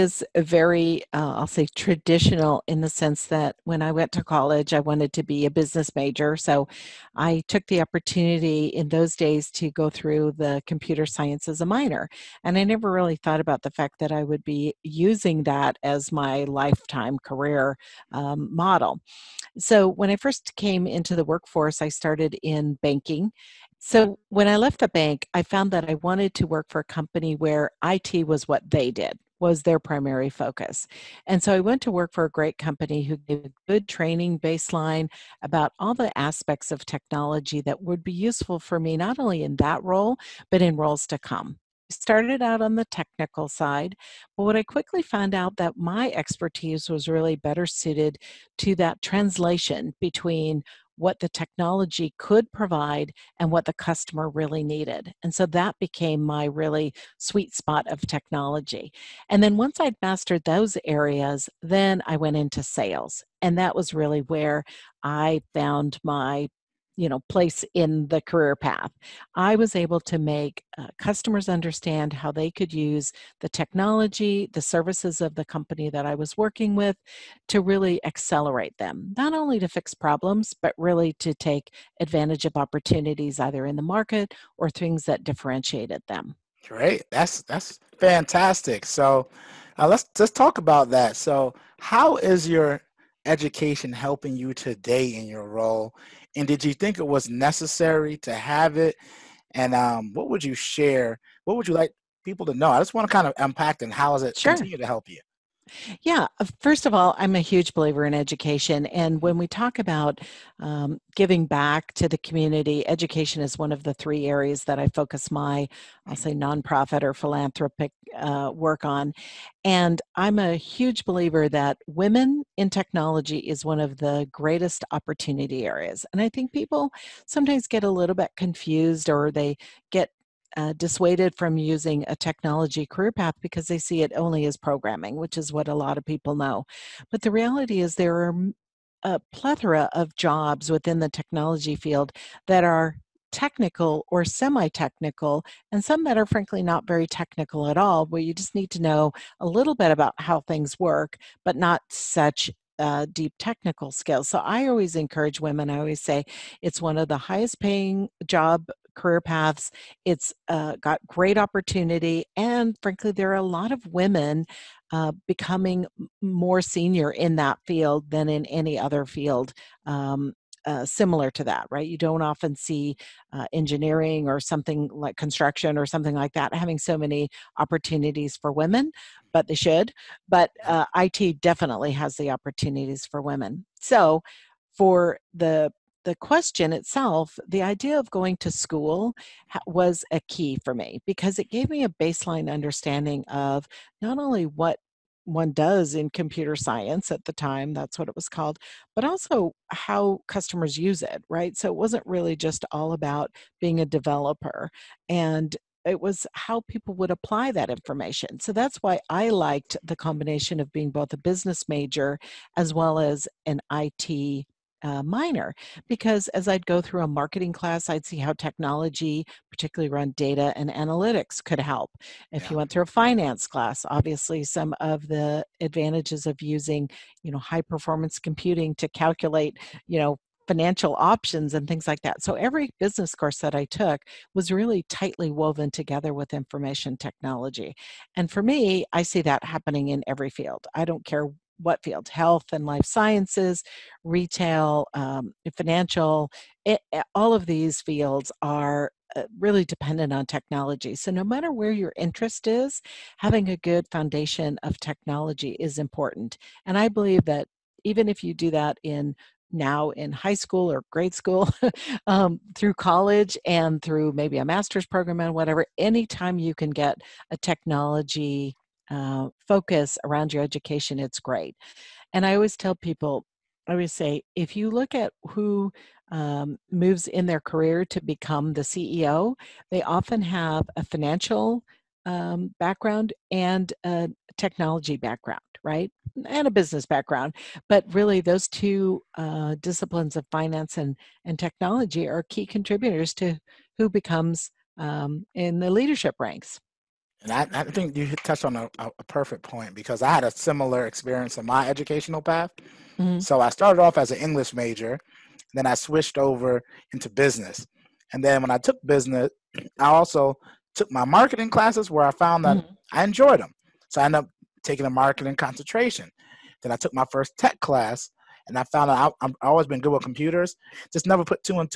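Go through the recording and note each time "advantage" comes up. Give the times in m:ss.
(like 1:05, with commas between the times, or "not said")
1:22, 3:45.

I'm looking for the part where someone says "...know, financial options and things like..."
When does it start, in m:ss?
3:49.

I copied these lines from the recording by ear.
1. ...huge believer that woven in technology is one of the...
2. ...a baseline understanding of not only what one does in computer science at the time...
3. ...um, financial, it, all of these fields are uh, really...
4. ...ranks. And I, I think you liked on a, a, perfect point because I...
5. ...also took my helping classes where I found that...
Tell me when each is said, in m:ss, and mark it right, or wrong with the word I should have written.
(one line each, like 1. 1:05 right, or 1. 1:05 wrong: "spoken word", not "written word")
1. 2:00 wrong: "women", not "woven"
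2. 3:11 right
3. 4:04 right
4. 4:56 wrong: "touched", not "liked"
5. 5:09 wrong: "marketing", not "helping".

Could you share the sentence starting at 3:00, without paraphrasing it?
But uh, IT definitely has the opportunities for women.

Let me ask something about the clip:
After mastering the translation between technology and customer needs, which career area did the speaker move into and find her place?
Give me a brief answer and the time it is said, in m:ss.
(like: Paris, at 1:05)
sales, at 1:02.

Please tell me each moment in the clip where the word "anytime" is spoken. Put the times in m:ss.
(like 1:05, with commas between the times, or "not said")
4:25.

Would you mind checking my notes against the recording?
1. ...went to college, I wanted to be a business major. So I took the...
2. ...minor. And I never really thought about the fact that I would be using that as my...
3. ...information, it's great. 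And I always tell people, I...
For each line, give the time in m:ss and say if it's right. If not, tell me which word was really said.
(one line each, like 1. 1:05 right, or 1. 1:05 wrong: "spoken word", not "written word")
1. 0:03 right
2. 0:11 right
3. 4:30 wrong: "education", not "information".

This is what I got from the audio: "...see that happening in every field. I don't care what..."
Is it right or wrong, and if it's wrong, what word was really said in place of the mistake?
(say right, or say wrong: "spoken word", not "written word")
right.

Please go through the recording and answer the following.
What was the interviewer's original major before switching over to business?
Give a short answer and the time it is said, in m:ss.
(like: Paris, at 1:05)
English, at 5:04.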